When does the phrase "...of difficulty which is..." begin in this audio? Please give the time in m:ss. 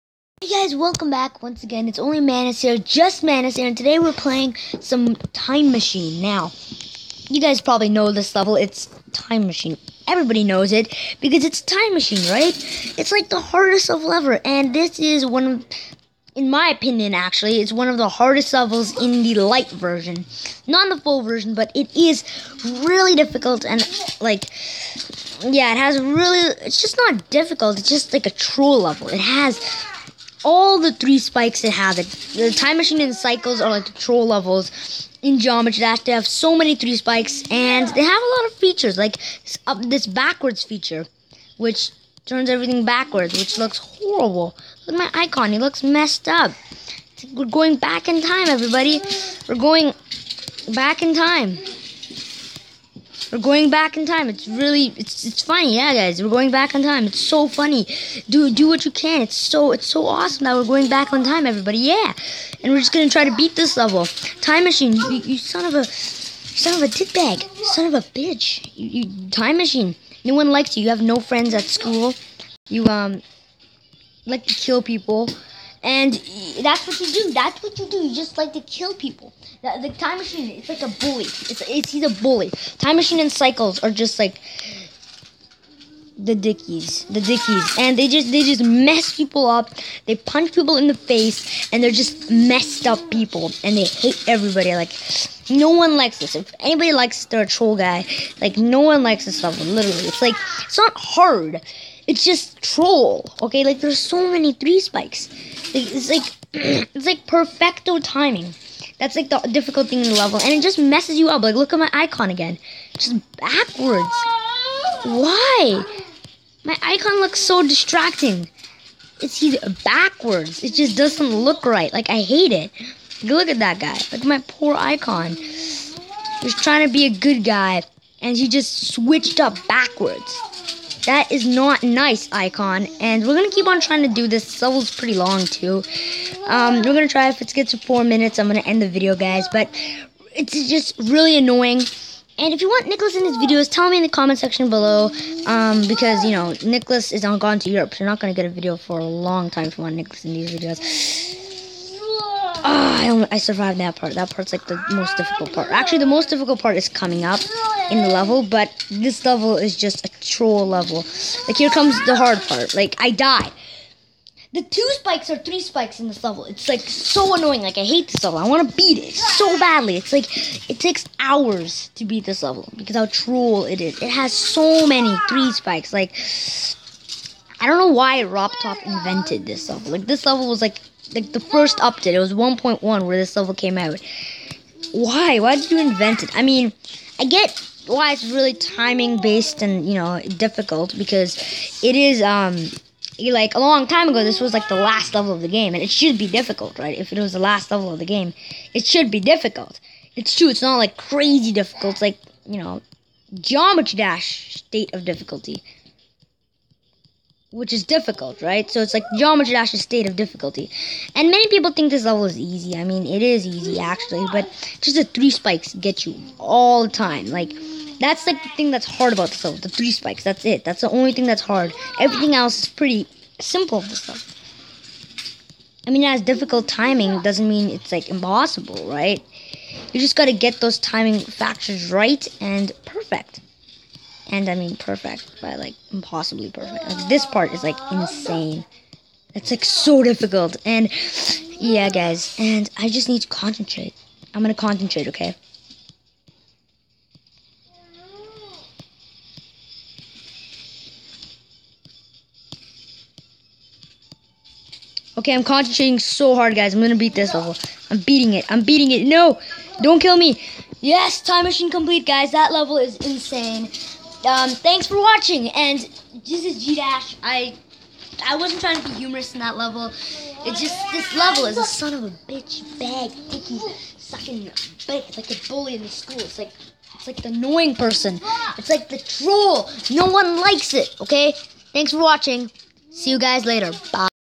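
3:24.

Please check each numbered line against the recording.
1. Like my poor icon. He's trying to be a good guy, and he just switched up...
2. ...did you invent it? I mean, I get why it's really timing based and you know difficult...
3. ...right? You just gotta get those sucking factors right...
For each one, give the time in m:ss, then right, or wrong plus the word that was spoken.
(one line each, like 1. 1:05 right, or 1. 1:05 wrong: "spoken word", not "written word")
1. 2:04 right
2. 3:05 right
3. 3:48 wrong: "timing", not "sucking".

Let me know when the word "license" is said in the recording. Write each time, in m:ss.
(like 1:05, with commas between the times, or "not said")
not said.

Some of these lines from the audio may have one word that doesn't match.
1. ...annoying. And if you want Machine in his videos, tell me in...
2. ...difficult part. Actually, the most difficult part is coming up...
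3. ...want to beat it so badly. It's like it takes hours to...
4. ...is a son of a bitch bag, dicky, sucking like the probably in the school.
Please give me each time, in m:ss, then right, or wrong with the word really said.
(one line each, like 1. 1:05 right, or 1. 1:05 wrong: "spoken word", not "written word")
1. 2:21 wrong: "Nicholas", not "Machine"
2. 2:35 right
3. 2:48 right
4. 4:31 wrong: "bully", not "probably".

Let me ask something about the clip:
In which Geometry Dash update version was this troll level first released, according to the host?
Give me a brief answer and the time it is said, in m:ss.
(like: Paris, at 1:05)
1.1, at 3:02.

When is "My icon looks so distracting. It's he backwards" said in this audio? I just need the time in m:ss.
1:56.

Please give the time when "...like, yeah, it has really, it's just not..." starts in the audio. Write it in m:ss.
0:24.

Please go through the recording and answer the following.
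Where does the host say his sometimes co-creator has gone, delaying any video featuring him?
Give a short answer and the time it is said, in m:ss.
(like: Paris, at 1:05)
Europe, at 2:27.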